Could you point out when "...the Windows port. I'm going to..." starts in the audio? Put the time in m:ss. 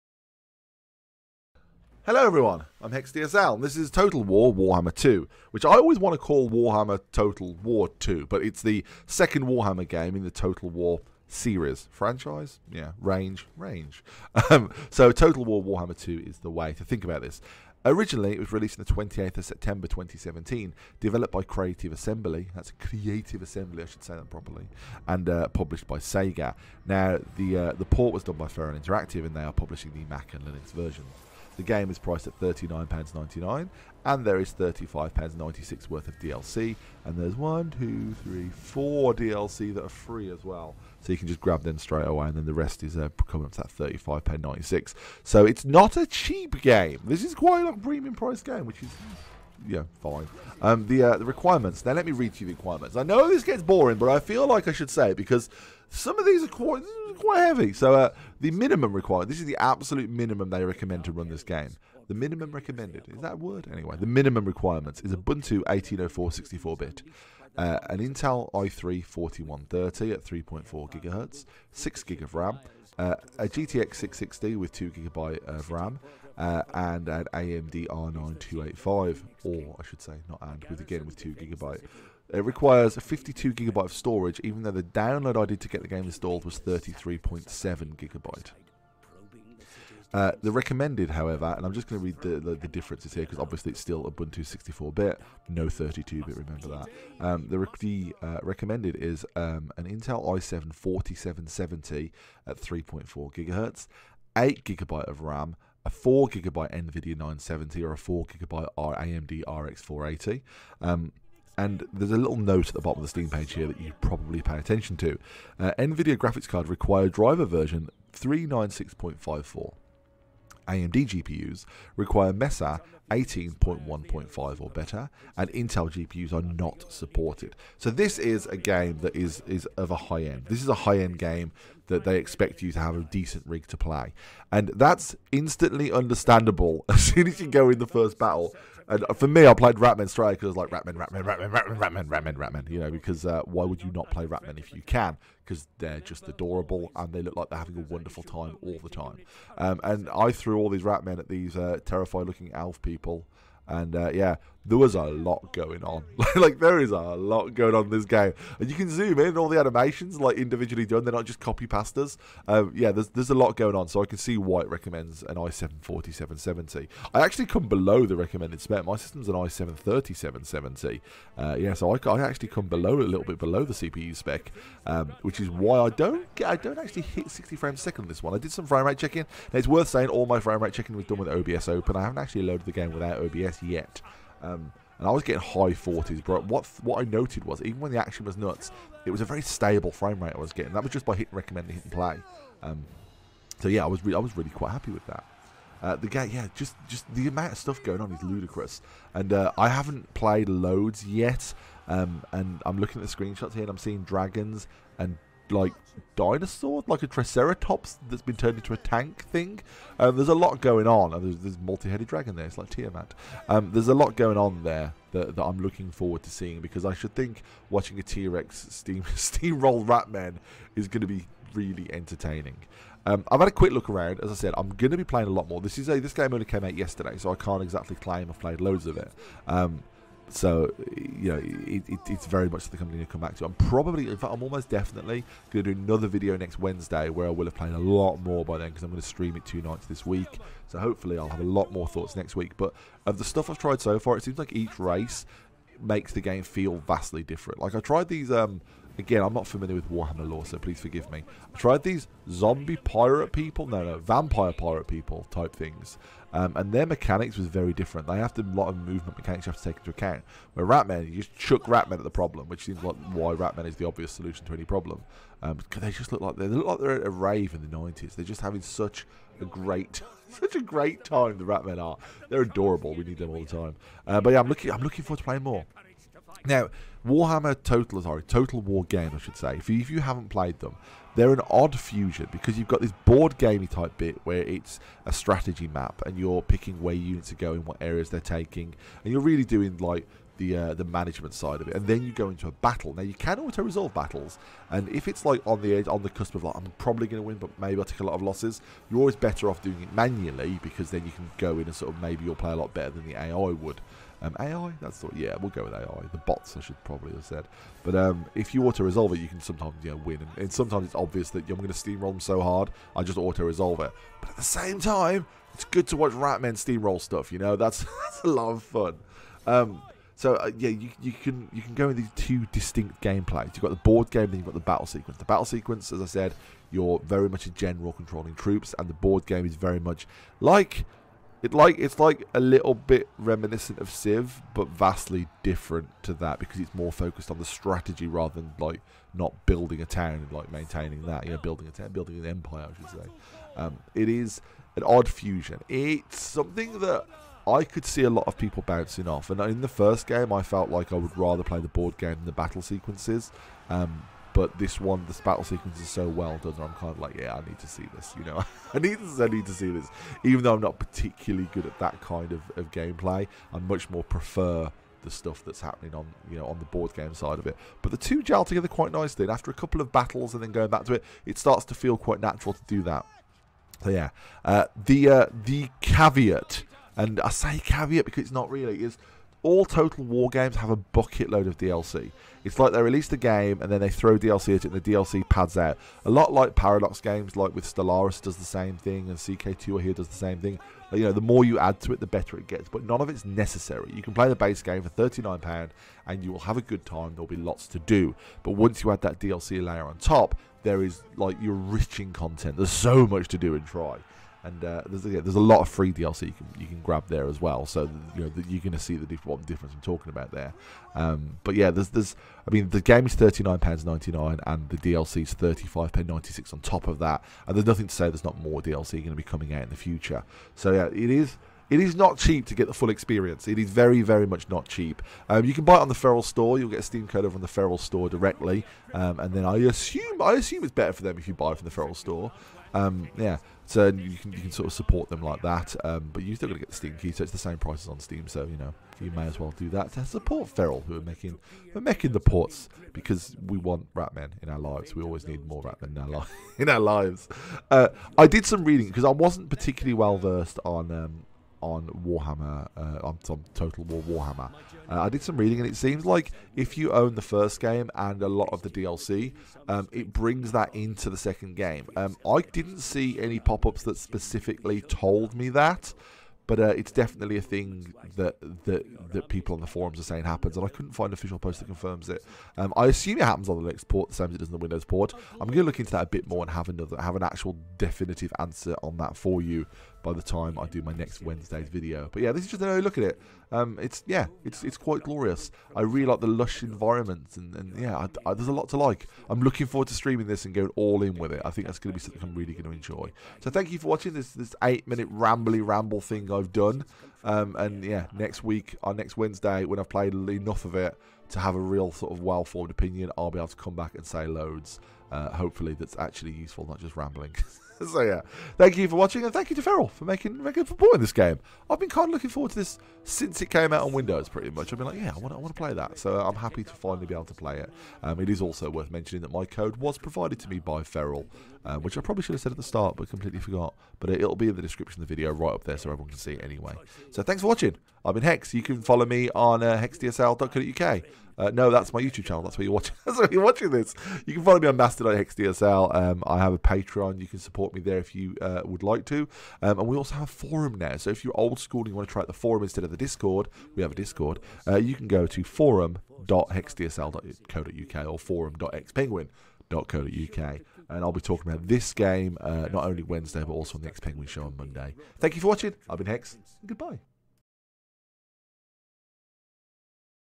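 7:54.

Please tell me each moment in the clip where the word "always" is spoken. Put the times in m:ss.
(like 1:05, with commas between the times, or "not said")
0:05, 4:58, 7:25.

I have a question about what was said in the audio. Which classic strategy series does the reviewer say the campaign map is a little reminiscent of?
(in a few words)
Civ.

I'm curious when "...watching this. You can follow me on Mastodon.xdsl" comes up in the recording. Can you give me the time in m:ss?
8:53.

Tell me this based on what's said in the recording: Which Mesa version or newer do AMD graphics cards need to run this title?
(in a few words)
18.1.5.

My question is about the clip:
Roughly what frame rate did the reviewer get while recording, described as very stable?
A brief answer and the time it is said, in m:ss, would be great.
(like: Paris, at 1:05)
high 40s, at 3:05.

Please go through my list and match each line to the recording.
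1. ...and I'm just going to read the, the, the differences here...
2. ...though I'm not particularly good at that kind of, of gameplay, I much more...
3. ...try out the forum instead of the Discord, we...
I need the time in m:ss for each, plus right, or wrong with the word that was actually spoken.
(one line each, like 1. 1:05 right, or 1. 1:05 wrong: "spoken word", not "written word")
1. 1:31 right
2. 6:00 right
3. 9:02 right.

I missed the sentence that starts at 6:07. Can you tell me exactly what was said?
But the two gel together quite nicely.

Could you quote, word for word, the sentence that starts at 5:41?
You know, building a town, building an empire, I should say.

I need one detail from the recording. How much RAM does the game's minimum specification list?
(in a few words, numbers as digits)
6 GB.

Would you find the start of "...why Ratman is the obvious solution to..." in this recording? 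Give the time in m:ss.
4:23.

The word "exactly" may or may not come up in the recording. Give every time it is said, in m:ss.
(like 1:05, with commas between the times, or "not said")
3:47.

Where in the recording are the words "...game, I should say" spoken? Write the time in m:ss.
4:38.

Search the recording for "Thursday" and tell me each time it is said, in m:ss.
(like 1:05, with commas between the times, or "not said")
not said.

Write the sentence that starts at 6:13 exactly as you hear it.
So yeah, uh, the uh, the caveat and I say caveat because it's not really.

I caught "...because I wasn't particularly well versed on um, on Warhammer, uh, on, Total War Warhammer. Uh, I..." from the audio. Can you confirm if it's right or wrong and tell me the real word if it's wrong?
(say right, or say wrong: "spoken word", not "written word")
right.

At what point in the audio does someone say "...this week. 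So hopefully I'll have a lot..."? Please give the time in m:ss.
3:59.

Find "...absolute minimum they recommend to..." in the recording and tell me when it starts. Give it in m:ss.
0:59.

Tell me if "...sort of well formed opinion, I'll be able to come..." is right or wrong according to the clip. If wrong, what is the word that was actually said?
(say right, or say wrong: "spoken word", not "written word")
right.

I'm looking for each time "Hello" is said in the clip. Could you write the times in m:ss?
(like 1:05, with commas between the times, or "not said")
0:02.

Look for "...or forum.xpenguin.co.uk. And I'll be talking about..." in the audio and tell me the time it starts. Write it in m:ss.
9:08.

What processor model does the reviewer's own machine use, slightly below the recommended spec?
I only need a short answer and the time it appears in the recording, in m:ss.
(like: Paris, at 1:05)
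i7 3770, at 2:49.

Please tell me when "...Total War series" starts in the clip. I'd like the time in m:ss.
0:10.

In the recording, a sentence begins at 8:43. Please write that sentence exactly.
But it, will be in the description of the video right up there, so everyone can see it anyway.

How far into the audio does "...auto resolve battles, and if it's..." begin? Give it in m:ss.
4:53.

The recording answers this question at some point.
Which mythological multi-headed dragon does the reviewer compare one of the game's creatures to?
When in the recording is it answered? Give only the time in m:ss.
3:32.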